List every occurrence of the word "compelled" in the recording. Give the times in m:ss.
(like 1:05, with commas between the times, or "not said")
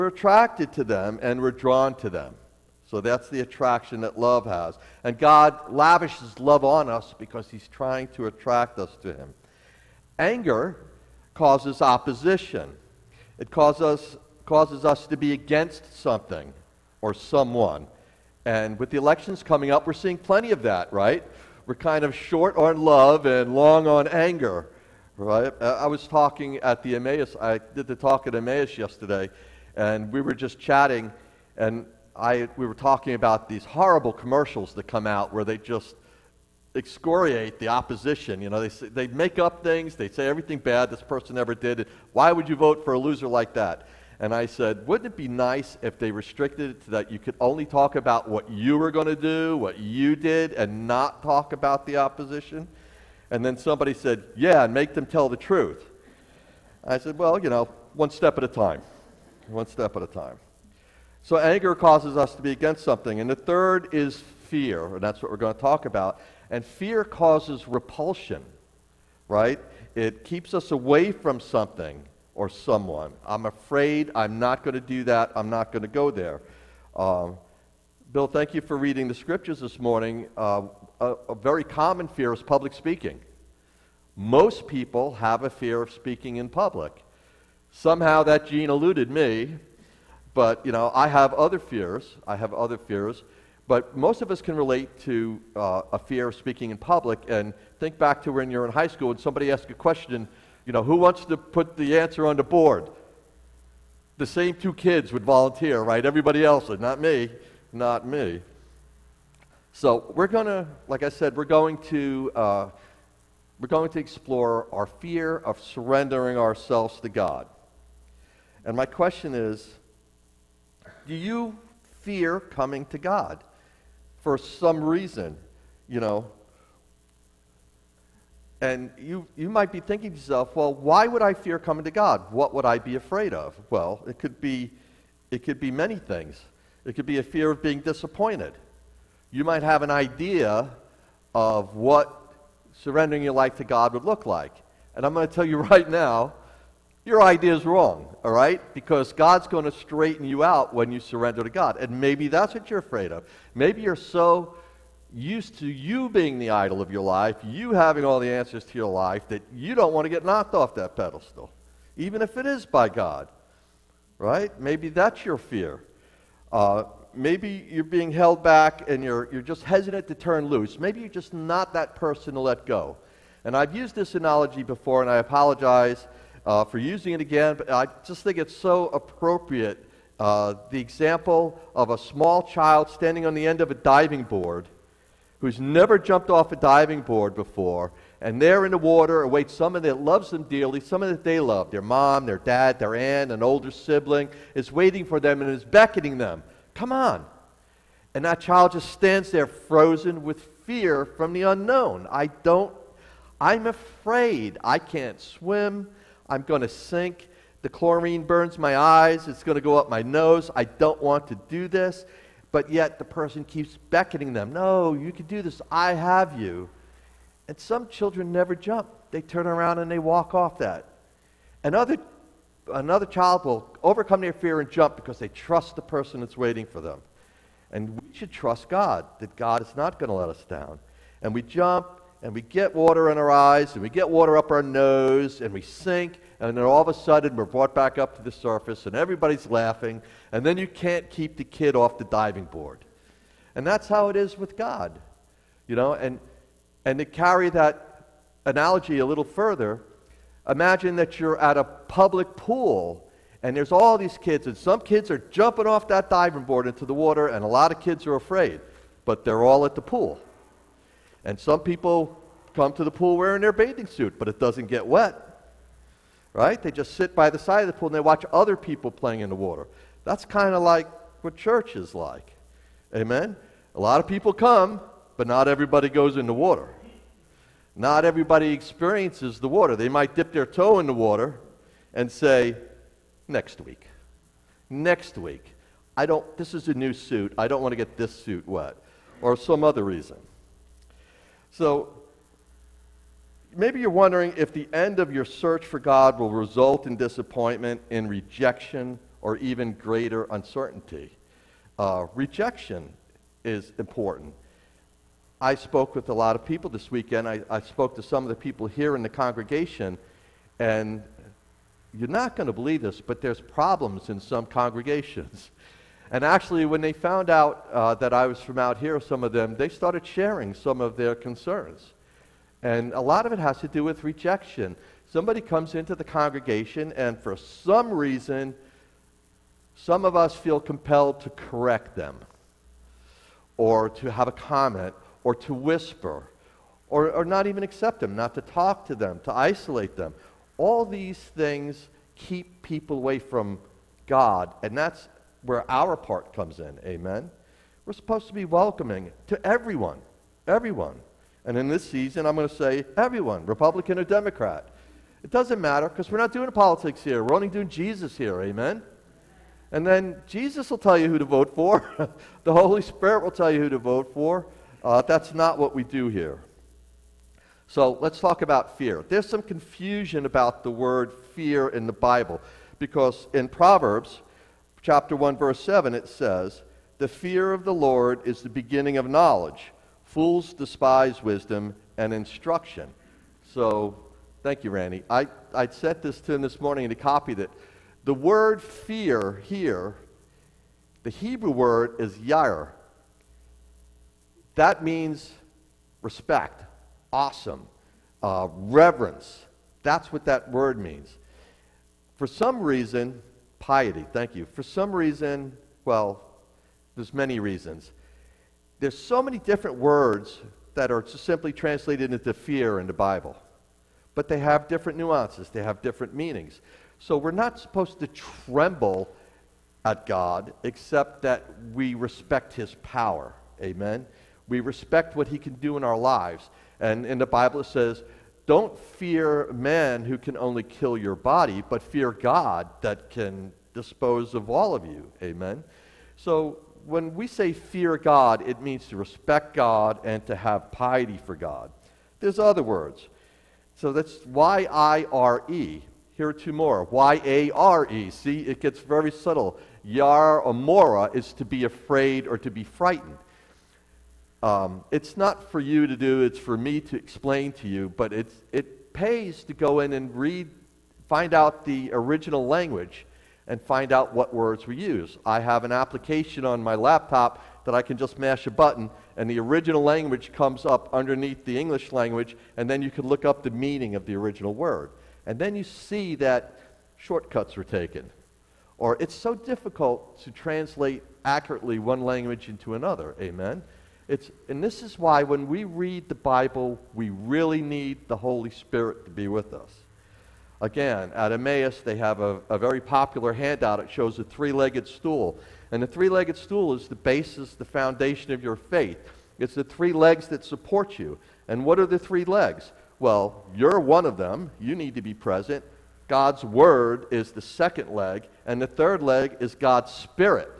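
5:30.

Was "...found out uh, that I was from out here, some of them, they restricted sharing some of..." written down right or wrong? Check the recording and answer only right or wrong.
wrong.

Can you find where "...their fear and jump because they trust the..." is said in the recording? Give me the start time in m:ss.
3:44.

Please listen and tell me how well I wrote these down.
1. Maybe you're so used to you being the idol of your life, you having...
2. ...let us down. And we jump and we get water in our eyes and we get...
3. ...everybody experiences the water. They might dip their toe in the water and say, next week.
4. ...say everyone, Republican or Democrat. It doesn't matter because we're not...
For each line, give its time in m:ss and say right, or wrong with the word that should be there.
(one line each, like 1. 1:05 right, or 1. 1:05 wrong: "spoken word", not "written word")
1. 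2:33 right
2. 3:50 right
3. 4:38 right
4. 5:52 right.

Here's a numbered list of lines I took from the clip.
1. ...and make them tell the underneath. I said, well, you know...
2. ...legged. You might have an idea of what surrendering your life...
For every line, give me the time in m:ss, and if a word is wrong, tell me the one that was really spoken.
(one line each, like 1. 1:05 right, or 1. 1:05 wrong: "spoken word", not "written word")
1. 0:54 wrong: "truth", not "underneath"
2. 2:17 wrong: "disappointed", not "legged".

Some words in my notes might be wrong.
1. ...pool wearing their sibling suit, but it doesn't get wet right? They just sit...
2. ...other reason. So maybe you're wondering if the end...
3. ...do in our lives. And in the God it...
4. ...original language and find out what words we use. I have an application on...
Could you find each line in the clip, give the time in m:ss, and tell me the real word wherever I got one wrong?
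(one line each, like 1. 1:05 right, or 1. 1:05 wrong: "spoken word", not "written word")
1. 4:22 wrong: "bathing", not "sibling"
2. 4:49 right
3. 7:05 wrong: "Bible", not "God"
4. 7:41 right.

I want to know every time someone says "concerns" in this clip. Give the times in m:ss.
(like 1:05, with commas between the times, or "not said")
5:21.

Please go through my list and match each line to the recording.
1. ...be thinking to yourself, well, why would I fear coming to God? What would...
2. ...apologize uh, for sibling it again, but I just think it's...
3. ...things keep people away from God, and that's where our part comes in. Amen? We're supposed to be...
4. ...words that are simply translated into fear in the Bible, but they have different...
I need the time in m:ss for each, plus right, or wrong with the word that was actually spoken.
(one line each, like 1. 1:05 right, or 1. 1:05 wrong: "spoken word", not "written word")
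1. 2:09 right
2. 2:55 wrong: "using", not "sibling"
3. 5:41 right
4. 6:49 right.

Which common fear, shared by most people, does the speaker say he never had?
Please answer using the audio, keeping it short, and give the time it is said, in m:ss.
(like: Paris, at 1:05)
Public speaking, at 1:22.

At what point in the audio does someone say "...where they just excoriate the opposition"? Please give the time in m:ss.
0:35.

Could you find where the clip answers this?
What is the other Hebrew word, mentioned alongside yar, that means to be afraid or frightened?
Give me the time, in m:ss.
7:30.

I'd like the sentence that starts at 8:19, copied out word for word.
It's the three legs that support you.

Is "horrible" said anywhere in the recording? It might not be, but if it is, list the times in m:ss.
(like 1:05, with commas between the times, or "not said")
0:33.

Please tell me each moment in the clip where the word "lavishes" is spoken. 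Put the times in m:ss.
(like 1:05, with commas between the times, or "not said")
0:05.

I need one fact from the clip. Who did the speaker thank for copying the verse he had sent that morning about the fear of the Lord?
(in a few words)
Randy.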